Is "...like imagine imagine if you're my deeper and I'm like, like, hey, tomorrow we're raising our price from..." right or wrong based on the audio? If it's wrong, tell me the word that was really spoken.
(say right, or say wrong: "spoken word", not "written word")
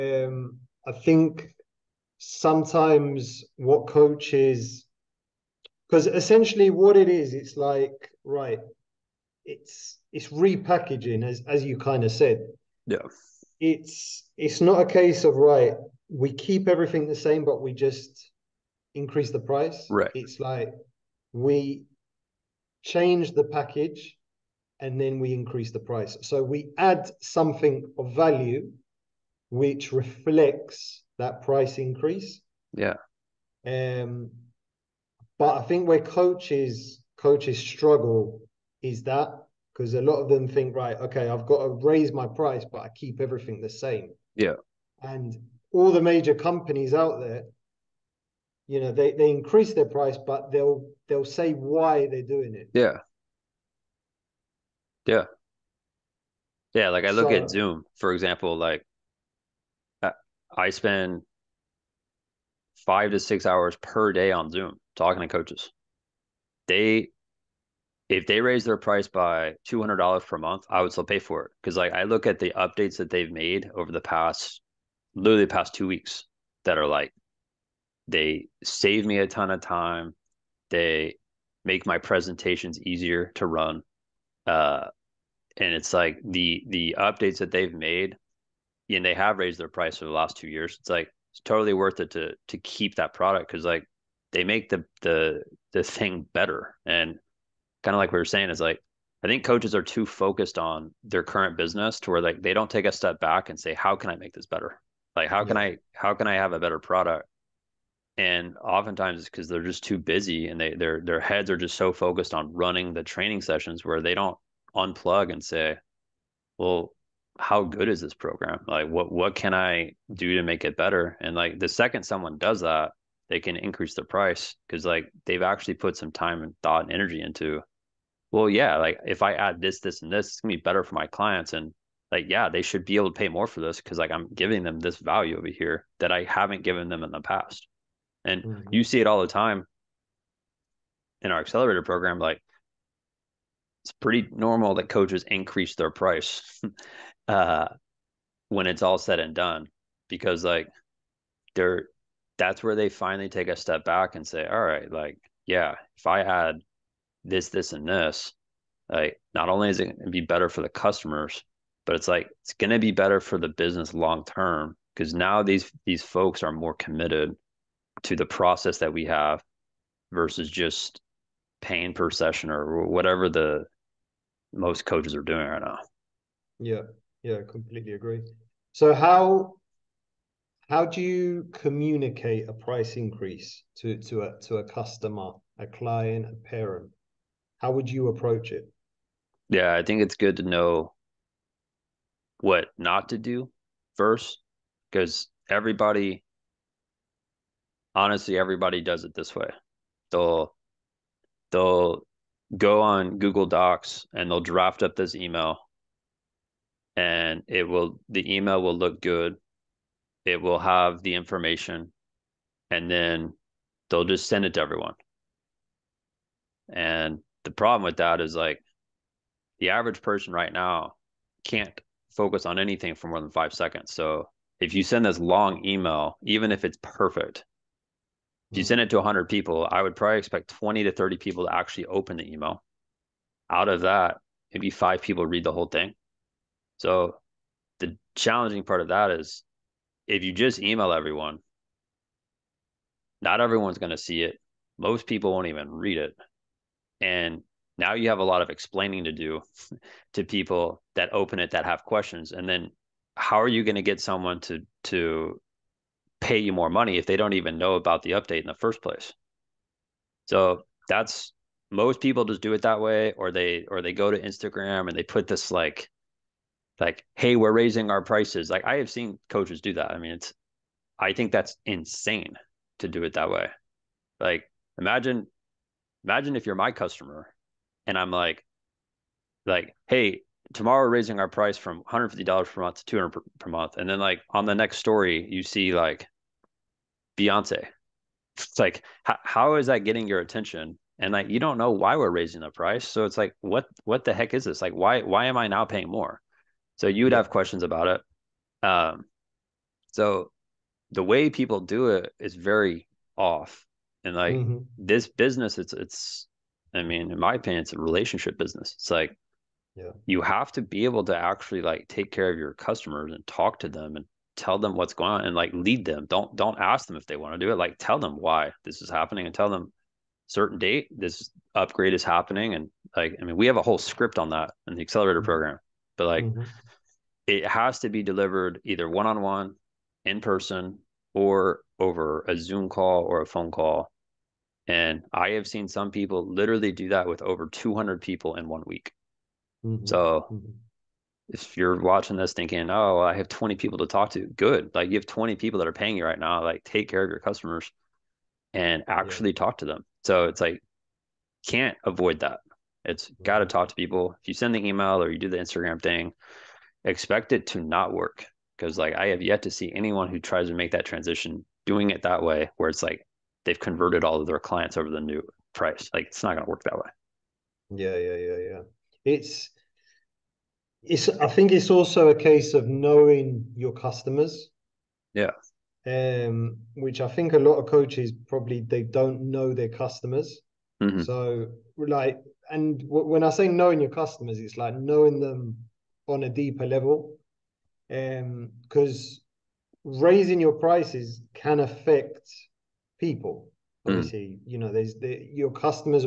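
wrong: "customer", not "deeper".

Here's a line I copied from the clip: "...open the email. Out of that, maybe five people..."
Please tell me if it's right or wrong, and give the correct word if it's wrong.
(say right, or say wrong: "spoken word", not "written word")
right.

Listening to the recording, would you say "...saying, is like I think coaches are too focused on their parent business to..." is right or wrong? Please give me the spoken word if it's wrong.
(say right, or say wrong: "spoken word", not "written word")
wrong: "current", not "parent".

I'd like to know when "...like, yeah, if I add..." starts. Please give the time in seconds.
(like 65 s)
154 s.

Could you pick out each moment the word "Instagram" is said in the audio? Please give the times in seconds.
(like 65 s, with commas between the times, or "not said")
264 s, 355 s.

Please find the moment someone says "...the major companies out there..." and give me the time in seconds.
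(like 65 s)
45 s.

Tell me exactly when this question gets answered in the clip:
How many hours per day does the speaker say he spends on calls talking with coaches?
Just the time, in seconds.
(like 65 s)
62 s.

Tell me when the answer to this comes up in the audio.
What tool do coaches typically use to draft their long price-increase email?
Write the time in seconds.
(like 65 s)
203 s.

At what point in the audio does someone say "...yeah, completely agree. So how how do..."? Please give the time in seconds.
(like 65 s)
177 s.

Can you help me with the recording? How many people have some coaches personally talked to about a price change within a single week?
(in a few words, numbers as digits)
over 200.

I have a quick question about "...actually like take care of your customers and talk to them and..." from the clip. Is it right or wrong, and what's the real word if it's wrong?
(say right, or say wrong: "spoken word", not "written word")
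right.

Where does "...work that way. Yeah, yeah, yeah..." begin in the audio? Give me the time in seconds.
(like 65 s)
366 s.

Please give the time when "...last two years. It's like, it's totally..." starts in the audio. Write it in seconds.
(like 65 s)
90 s.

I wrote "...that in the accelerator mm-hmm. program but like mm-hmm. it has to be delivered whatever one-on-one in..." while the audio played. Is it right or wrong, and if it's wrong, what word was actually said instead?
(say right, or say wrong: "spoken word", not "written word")
wrong: "either", not "whatever".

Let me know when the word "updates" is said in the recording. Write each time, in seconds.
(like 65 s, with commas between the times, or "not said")
72 s, 86 s, 258 s.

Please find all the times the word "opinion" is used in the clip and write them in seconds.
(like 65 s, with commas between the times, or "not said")
307 s.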